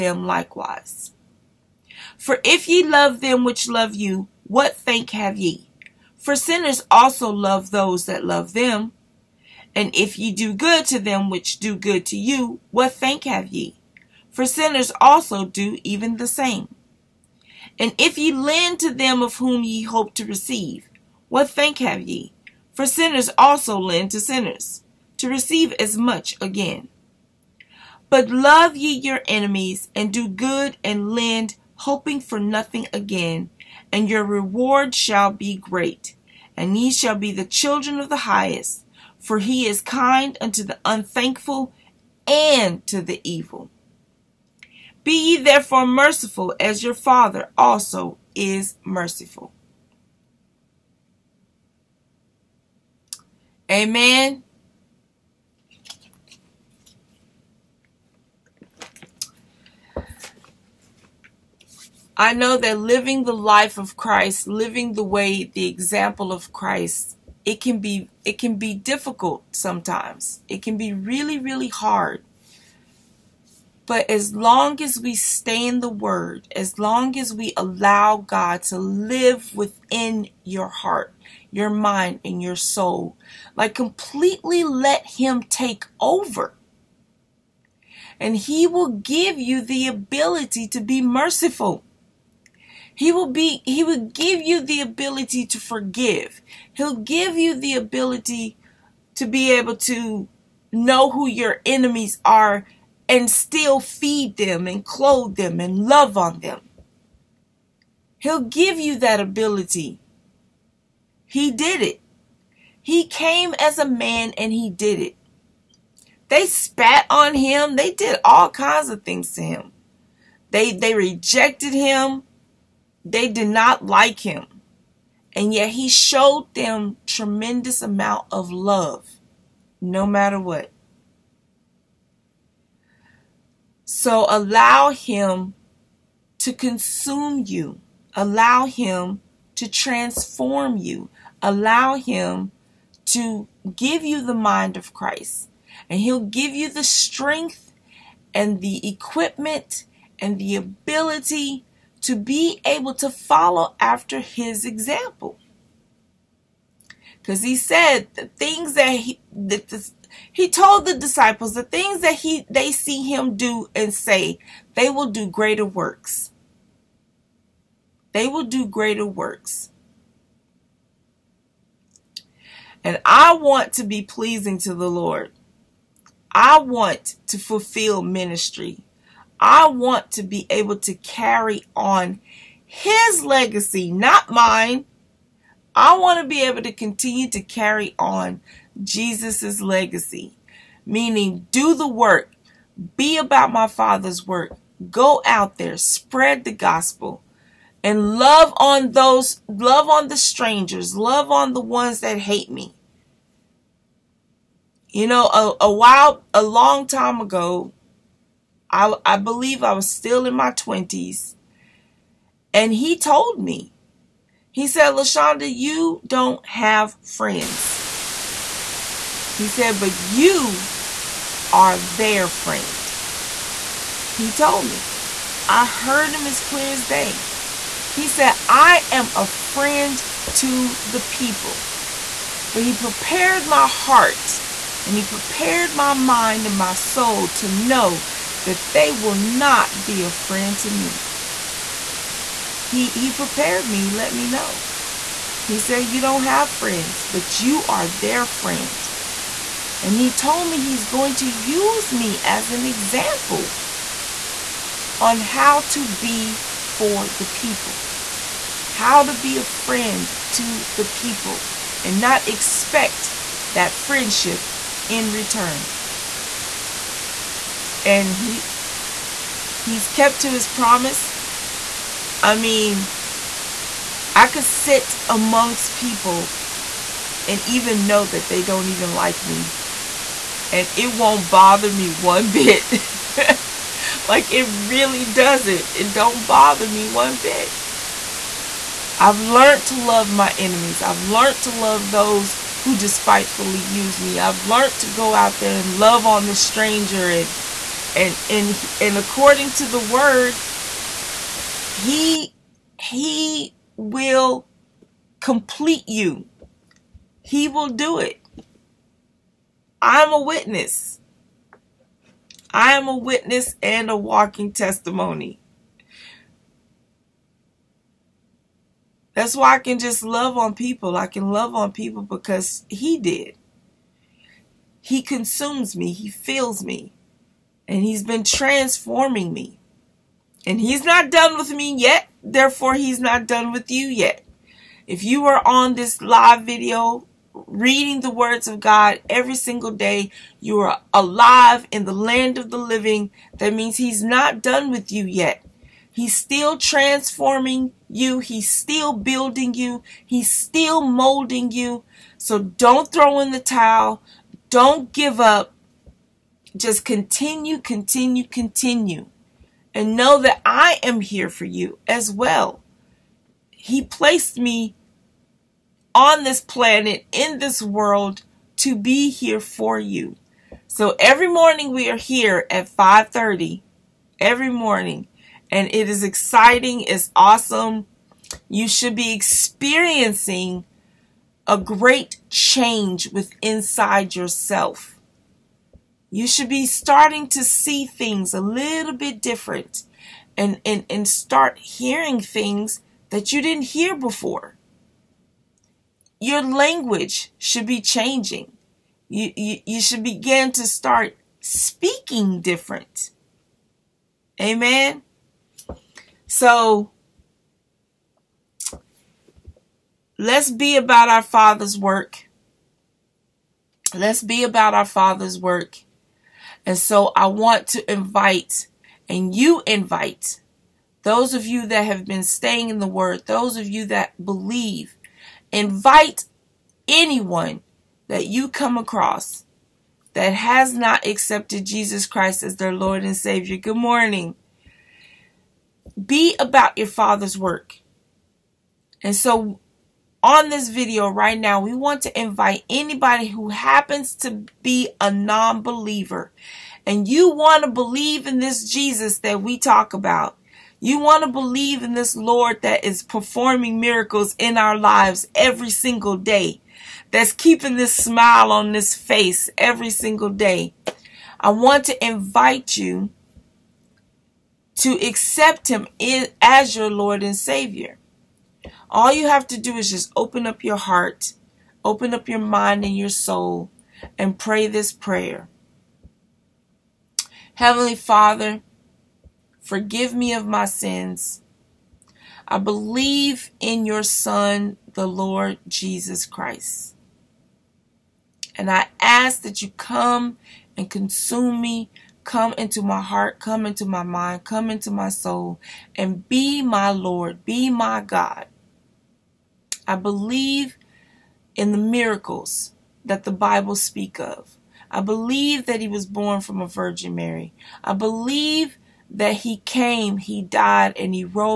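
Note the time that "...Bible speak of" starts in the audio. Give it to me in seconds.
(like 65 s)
503 s.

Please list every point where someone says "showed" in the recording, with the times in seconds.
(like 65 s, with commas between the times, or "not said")
125 s.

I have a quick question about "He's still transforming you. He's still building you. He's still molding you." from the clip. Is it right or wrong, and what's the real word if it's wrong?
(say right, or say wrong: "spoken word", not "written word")
right.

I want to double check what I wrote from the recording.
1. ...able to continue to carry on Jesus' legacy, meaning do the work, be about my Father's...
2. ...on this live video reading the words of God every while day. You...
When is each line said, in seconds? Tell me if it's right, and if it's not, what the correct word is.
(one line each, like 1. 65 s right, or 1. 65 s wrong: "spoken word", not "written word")
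1. 186 s right
2. 335 s wrong: "single", not "while".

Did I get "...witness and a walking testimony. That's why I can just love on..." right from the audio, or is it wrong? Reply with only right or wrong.
right.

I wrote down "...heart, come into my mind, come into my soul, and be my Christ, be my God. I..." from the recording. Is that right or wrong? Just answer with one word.
wrong.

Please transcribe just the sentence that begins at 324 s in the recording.
He consumes me, He fills me, and He's been transforming me.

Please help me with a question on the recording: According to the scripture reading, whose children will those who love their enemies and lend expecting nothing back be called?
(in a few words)
the highest.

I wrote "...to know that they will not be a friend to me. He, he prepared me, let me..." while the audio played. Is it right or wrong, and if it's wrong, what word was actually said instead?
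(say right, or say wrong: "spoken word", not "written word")
right.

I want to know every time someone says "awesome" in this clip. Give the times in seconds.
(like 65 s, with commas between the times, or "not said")
377 s.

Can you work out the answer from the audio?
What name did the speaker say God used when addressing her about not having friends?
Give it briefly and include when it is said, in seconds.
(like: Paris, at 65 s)
Lashanda, at 214 s.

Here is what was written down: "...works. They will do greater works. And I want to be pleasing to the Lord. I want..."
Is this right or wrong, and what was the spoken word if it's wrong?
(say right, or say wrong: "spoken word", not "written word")
right.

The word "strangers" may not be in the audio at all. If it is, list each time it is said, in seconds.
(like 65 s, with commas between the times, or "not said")
200 s, 296 s.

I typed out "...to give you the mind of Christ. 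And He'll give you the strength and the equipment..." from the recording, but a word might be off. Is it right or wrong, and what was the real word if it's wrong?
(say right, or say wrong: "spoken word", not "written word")
right.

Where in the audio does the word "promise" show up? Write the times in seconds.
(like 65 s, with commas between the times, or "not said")
270 s.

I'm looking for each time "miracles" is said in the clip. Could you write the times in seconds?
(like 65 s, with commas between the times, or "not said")
453 s, 501 s.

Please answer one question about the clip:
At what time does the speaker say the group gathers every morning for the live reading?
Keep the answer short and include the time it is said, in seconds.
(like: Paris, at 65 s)
5:30, at 372 s.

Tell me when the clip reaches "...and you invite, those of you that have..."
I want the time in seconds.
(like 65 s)
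419 s.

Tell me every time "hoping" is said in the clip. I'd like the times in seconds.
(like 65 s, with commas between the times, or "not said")
31 s.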